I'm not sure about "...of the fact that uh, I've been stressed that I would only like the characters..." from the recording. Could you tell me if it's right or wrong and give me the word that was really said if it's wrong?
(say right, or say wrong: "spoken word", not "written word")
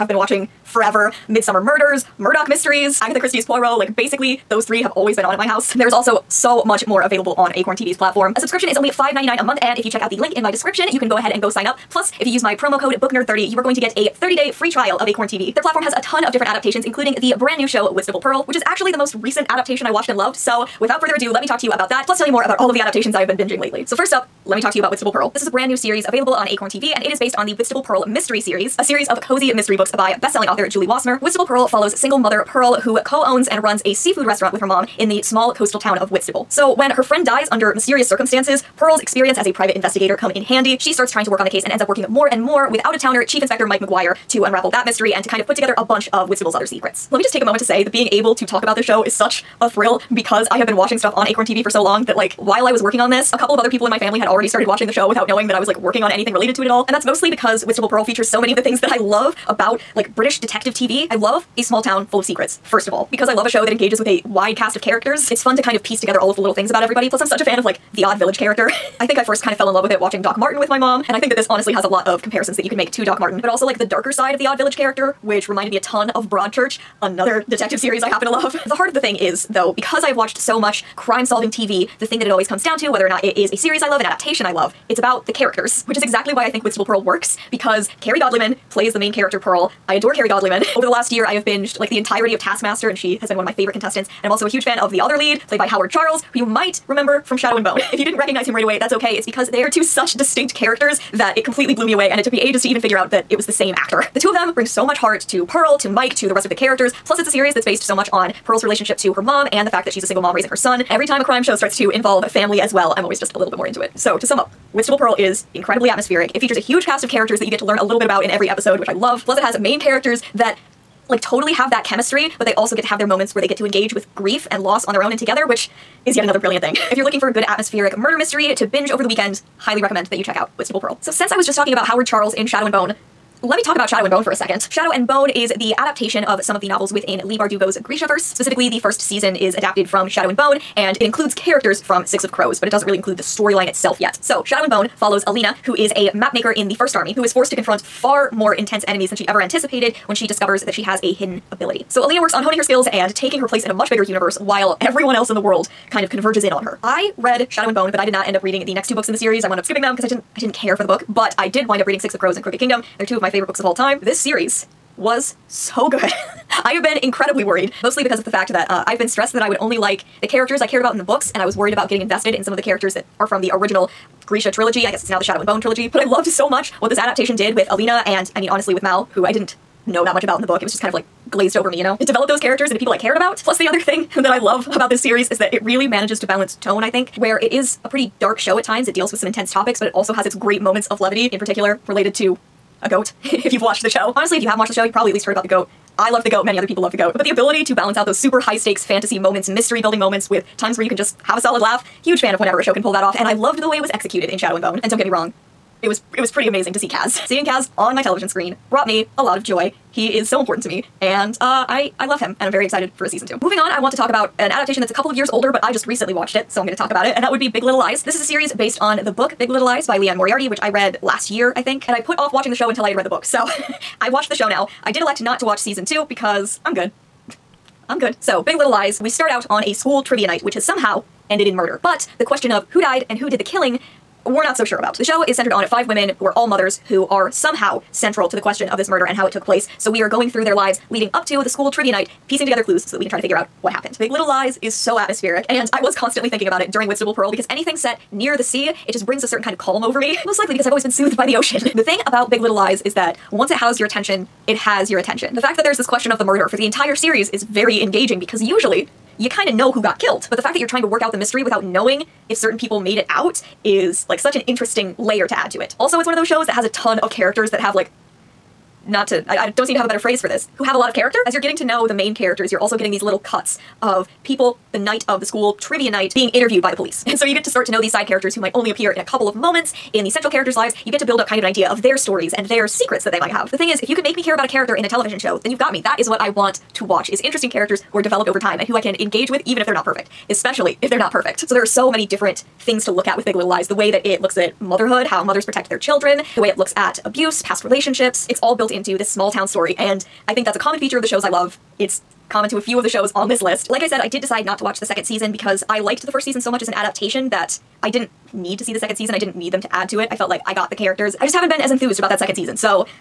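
right.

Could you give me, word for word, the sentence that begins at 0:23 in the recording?
So first up, let me talk to you about Whitstable Pearl.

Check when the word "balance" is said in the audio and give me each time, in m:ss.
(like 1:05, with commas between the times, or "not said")
3:06, 3:17.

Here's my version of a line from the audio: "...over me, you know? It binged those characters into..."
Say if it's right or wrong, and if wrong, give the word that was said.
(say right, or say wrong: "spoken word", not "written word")
wrong: "developed", not "binged".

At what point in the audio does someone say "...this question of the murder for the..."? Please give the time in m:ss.
4:15.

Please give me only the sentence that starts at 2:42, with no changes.
They're two of my favorite books of all time.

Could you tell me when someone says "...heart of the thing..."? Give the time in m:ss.
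1:18.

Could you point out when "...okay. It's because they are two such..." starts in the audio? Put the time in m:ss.
1:38.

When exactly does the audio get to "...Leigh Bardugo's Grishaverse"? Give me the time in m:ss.
2:17.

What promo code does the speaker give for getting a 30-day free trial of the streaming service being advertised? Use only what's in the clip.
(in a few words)
BookNerd30.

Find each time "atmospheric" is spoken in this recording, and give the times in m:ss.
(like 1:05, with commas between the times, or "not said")
1:55, 2:07, 4:04.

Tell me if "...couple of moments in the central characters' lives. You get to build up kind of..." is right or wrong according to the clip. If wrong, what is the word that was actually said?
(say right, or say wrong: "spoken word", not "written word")
right.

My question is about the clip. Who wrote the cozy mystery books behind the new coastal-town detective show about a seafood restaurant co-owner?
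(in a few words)
Julie Wassmer.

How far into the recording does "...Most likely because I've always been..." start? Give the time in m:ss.
4:10.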